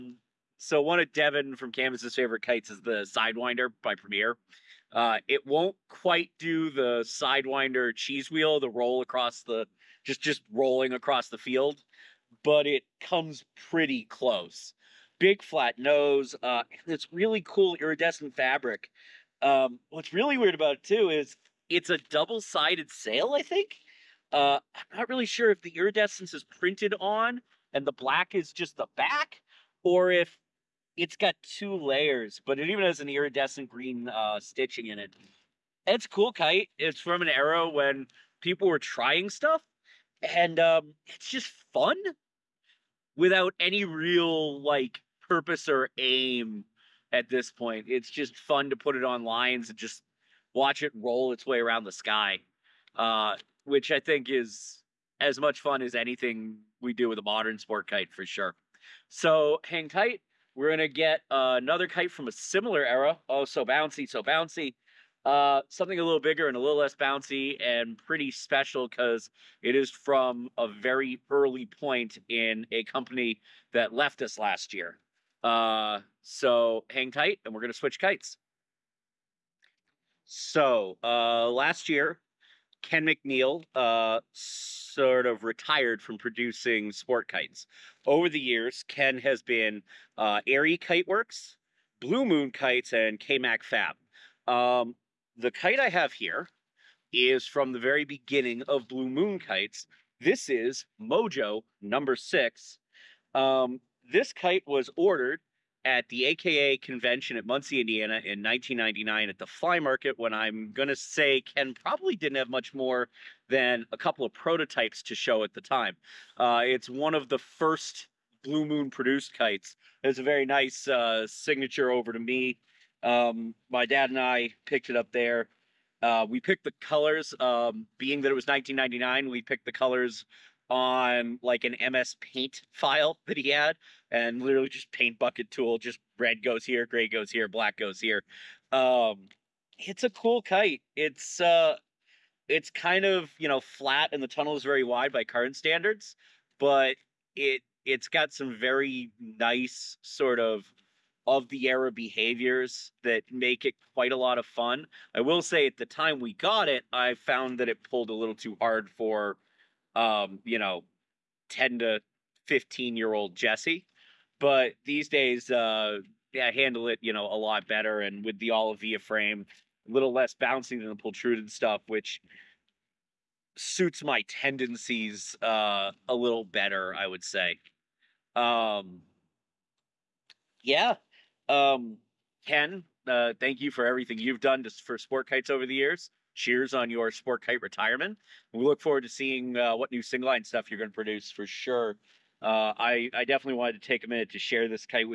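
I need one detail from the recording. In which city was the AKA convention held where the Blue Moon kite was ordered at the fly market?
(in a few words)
Muncie, Indiana.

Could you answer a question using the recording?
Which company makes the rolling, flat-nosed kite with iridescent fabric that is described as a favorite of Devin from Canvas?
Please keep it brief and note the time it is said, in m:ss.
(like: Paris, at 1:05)
Premier, at 0:03.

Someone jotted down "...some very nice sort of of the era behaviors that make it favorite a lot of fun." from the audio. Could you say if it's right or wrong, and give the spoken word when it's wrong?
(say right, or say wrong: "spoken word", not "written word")
wrong: "quite", not "favorite".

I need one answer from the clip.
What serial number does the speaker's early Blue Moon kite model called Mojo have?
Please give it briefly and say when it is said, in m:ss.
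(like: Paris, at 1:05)
6, at 1:42.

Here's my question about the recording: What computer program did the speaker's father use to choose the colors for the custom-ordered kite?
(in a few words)
MS Paint.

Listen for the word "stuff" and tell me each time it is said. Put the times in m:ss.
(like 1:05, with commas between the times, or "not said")
0:39, 2:51, 3:10.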